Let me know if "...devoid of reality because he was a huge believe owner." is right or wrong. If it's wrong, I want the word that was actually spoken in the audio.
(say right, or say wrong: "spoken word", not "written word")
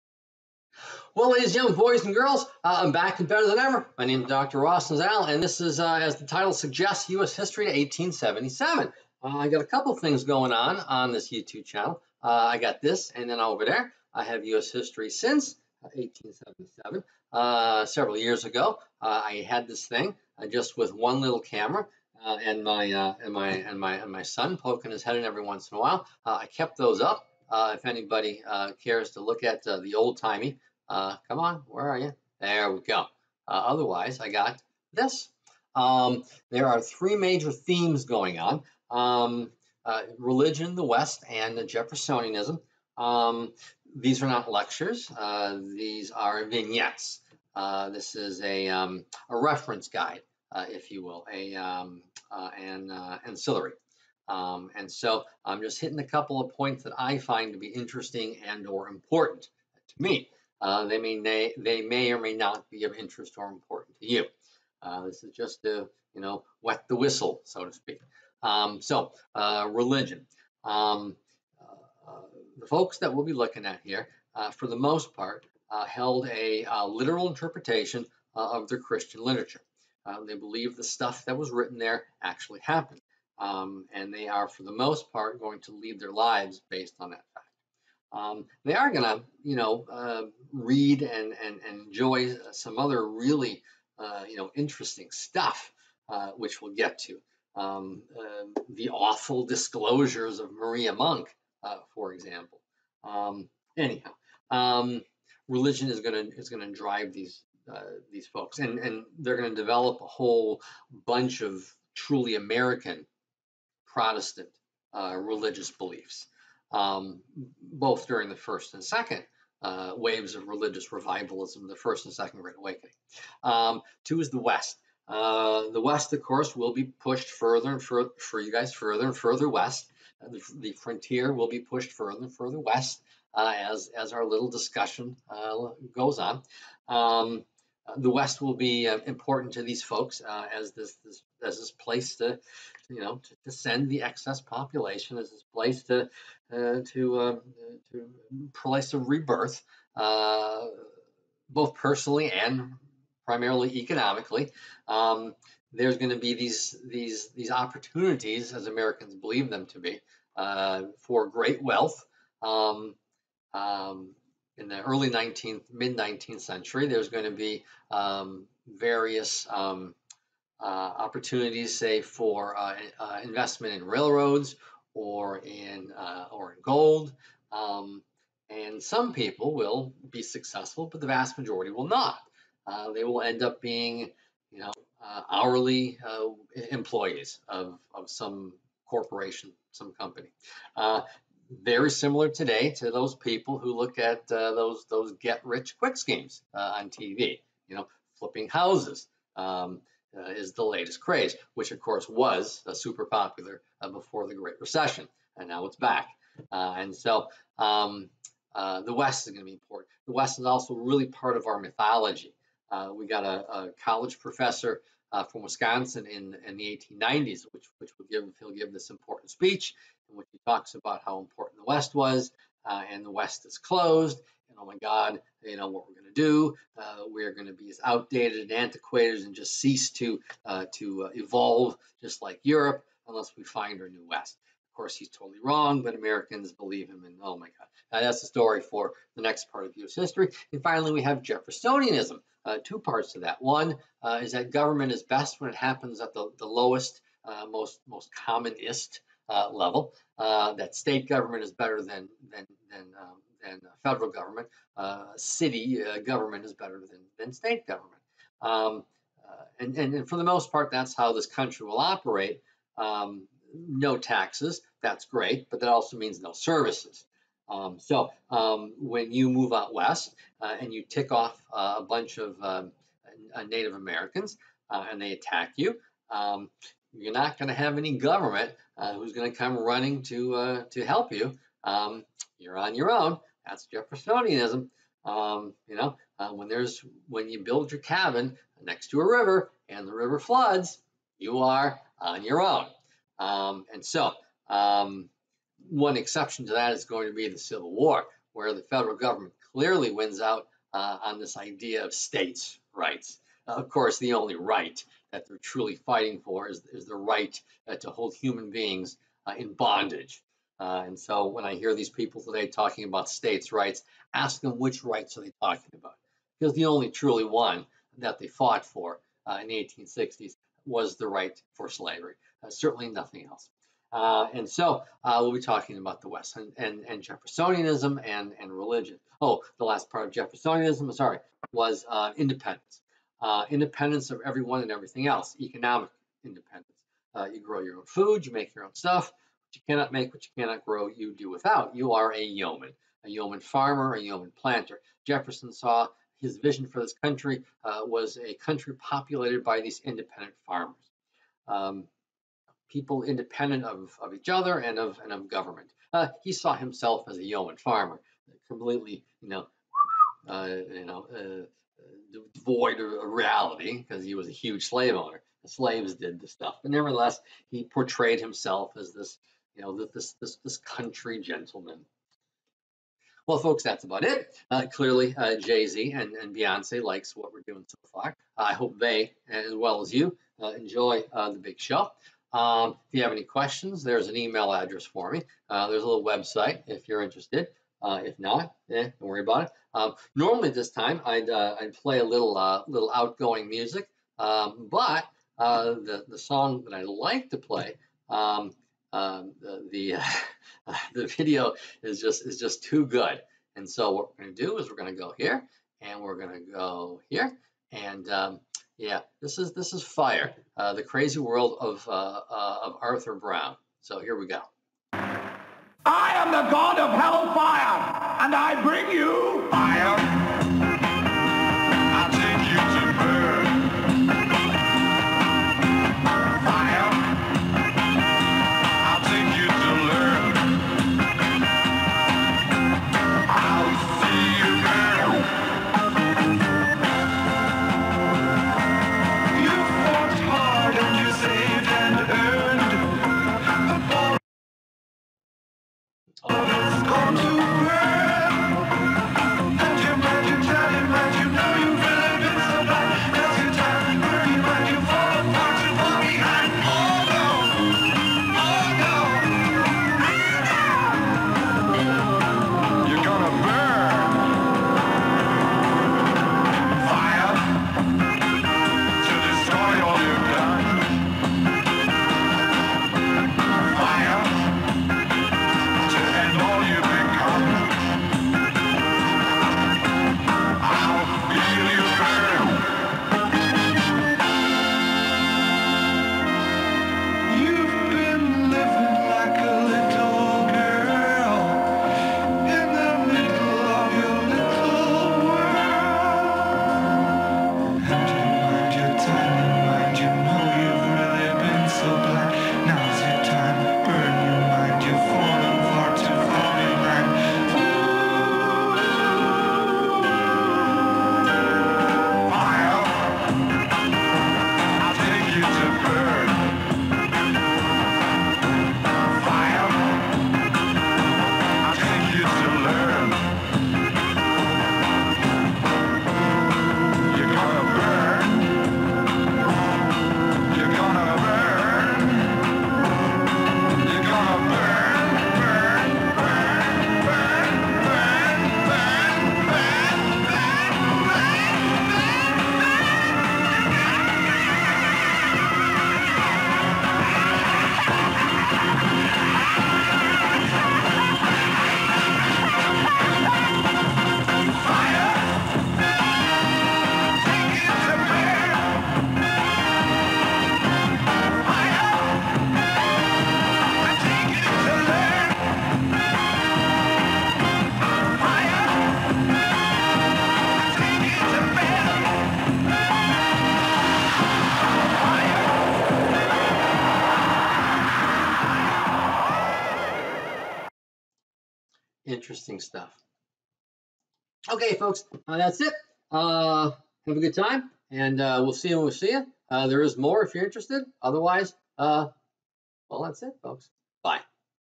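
wrong: "slave", not "believe".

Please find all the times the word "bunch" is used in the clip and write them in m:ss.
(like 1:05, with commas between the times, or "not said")
1:51, 4:31.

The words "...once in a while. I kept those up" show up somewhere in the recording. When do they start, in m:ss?
0:25.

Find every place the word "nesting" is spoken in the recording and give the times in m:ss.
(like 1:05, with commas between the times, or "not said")
not said.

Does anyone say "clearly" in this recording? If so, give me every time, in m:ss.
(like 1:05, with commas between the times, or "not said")
4:59, 6:14.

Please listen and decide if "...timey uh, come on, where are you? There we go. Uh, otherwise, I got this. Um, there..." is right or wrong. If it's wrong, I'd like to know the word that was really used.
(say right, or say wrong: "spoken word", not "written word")
right.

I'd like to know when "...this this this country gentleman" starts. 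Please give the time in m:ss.
6:09.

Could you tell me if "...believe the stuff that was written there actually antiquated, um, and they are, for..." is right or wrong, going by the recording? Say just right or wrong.
wrong.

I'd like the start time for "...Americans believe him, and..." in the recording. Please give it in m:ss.
3:55.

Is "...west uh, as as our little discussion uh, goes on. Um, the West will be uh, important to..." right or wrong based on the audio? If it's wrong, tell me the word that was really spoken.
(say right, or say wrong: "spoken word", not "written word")
right.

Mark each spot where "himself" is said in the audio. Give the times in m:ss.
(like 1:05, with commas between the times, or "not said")
5:56, 6:08.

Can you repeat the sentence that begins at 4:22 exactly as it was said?
Um, no taxes, that's great, but that also means no services.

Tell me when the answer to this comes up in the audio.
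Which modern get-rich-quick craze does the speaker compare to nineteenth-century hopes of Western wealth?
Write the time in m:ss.
3:18.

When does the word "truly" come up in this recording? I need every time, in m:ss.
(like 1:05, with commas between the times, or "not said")
1:51, 5:05, 5:16.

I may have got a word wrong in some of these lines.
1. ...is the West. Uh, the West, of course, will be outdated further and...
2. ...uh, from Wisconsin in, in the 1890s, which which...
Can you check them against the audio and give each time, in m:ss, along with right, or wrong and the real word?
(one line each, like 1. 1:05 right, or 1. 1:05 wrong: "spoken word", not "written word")
1. 2:04 wrong: "pushed", not "outdated"
2. 3:35 right.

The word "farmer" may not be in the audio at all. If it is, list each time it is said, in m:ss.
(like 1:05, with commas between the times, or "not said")
5:43, 5:50, 5:57.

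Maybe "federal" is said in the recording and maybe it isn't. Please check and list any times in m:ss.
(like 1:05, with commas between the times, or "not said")
4:13, 4:58.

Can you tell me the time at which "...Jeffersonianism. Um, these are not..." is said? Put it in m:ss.
0:41.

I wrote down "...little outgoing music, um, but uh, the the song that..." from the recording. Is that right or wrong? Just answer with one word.
right.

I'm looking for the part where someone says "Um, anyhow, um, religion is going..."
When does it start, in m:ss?
1:43.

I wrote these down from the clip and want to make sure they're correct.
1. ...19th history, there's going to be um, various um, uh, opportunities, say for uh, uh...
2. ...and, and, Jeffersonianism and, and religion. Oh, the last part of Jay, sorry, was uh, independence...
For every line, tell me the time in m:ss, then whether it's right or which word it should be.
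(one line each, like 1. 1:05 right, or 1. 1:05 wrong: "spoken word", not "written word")
1. 2:45 wrong: "century", not "history"
2. 5:26 wrong: "Jeffersonianism", not "Jay".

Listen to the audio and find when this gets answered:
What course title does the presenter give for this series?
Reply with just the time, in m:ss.
0:07.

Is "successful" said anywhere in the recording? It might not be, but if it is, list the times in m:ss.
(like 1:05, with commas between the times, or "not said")
3:00.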